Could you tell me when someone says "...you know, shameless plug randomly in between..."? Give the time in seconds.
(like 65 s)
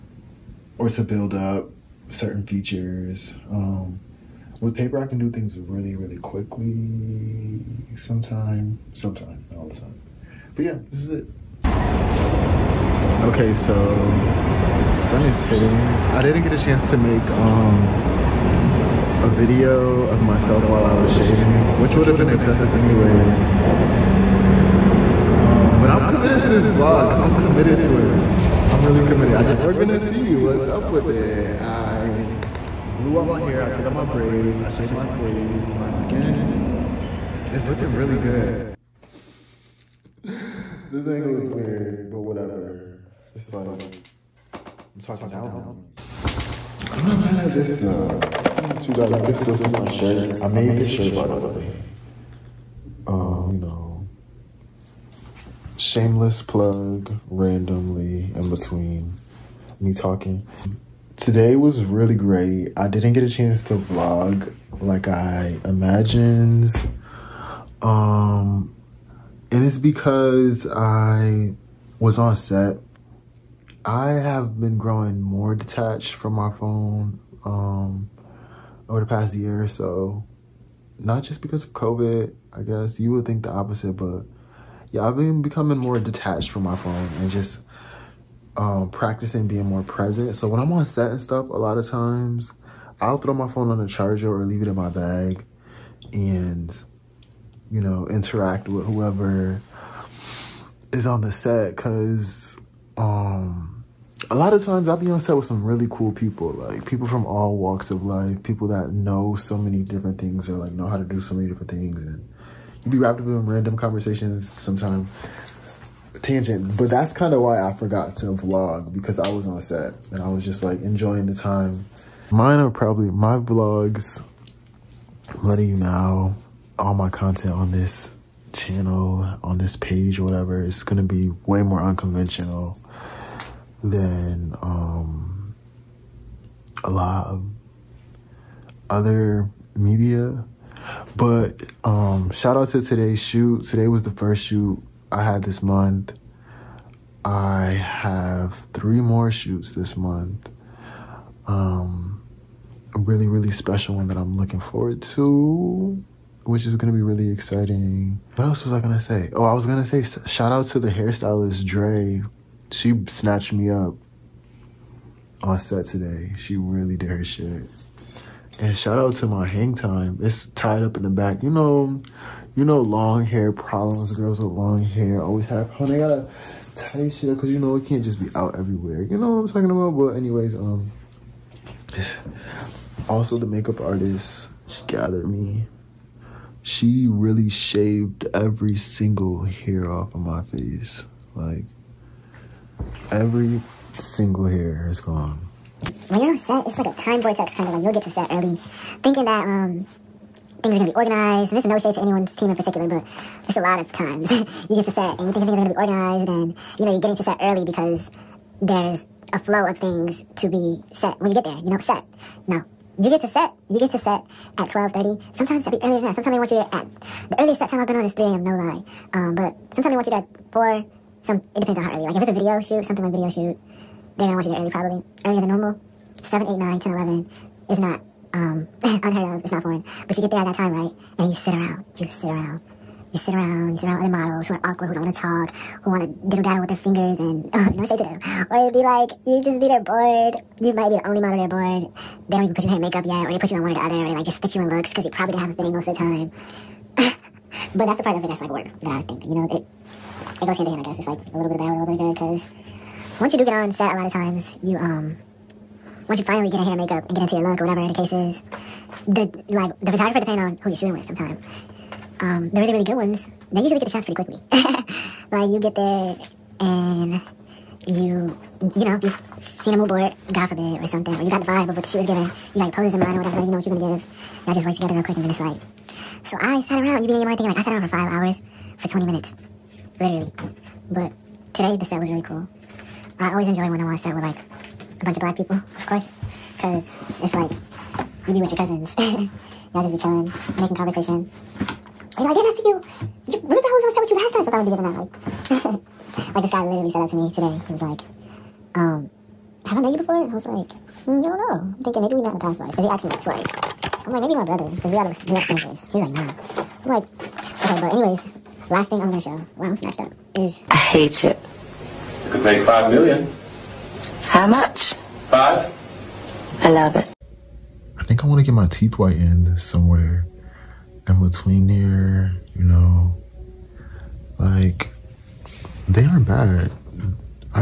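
53 s.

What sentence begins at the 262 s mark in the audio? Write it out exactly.
Um, the really really good ones, they usually get the shots pretty quickly.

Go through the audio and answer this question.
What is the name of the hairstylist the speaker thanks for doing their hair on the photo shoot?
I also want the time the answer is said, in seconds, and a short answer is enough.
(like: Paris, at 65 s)
Dre, at 161 s.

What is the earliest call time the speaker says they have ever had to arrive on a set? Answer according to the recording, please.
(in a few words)
3 a.m.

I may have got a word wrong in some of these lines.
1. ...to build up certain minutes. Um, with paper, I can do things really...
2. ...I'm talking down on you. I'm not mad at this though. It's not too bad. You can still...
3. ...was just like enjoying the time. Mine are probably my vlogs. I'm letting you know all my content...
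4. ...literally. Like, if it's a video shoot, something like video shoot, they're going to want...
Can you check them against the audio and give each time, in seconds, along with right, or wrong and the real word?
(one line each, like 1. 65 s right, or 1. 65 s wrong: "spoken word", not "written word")
1. 0 s wrong: "features", not "minutes"
2. 44 s right
3. 120 s right
4. 221 s wrong: "early", not "literally".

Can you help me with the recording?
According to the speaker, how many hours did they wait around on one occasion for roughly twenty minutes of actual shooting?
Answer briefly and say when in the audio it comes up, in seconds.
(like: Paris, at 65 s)
5, at 277 s.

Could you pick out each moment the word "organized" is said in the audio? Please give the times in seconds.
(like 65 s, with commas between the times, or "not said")
200 s, 205 s.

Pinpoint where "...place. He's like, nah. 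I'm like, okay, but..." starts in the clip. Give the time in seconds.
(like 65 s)
305 s.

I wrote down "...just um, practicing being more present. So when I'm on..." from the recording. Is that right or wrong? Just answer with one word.
right.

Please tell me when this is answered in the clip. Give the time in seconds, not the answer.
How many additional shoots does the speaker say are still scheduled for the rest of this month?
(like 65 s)
148 s.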